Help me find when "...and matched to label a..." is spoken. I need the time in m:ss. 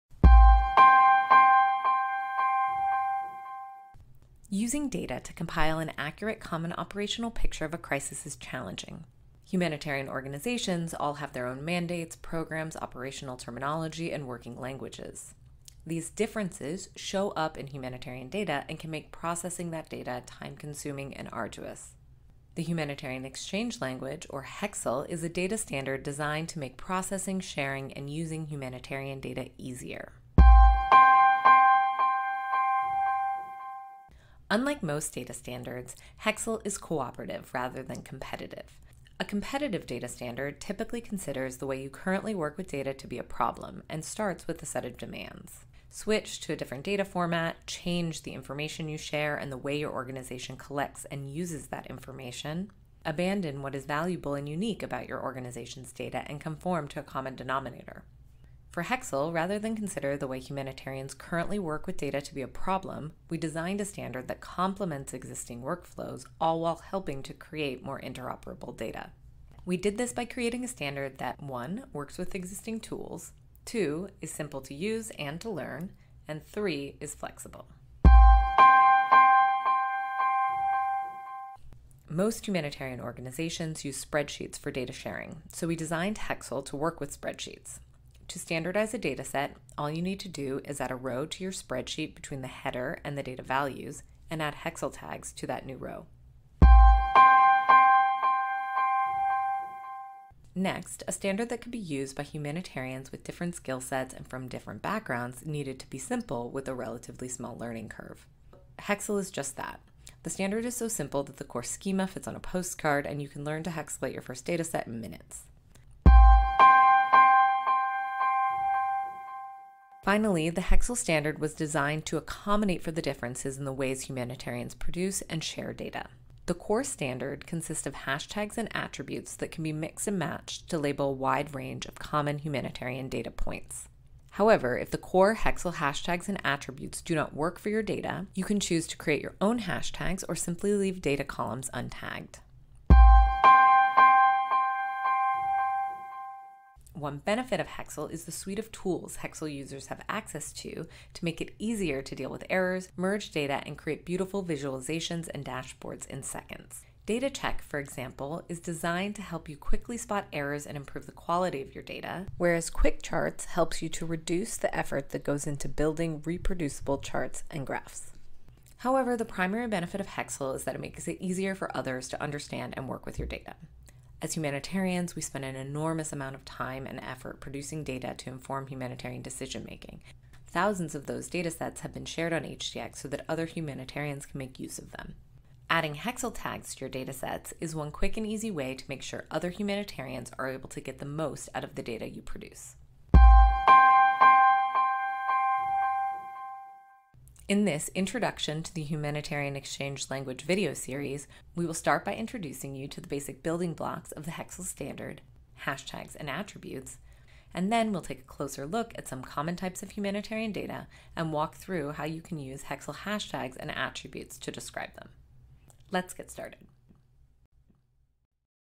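2:10.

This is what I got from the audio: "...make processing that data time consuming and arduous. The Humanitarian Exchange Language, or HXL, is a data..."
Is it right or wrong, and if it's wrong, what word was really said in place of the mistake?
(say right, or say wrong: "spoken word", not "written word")
right.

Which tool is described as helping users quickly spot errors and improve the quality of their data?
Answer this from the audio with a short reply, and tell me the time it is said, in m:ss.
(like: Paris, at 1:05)
Data Check, at 2:37.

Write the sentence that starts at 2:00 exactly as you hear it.
Finally, the Hexel Standard was designed to accommodate for the differences in the ways humanitarians produce and share data.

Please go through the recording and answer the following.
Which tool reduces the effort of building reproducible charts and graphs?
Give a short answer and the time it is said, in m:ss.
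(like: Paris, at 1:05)
Quick Charts, at 2:42.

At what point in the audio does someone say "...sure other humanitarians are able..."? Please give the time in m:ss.
3:09.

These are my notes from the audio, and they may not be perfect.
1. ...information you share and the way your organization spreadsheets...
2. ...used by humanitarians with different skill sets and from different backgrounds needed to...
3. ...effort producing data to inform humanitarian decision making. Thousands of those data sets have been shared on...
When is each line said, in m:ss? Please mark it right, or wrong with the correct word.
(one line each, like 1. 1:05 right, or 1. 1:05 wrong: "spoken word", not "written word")
1. 0:48 wrong: "collects", not "spreadsheets"
2. 1:41 right
3. 2:56 right.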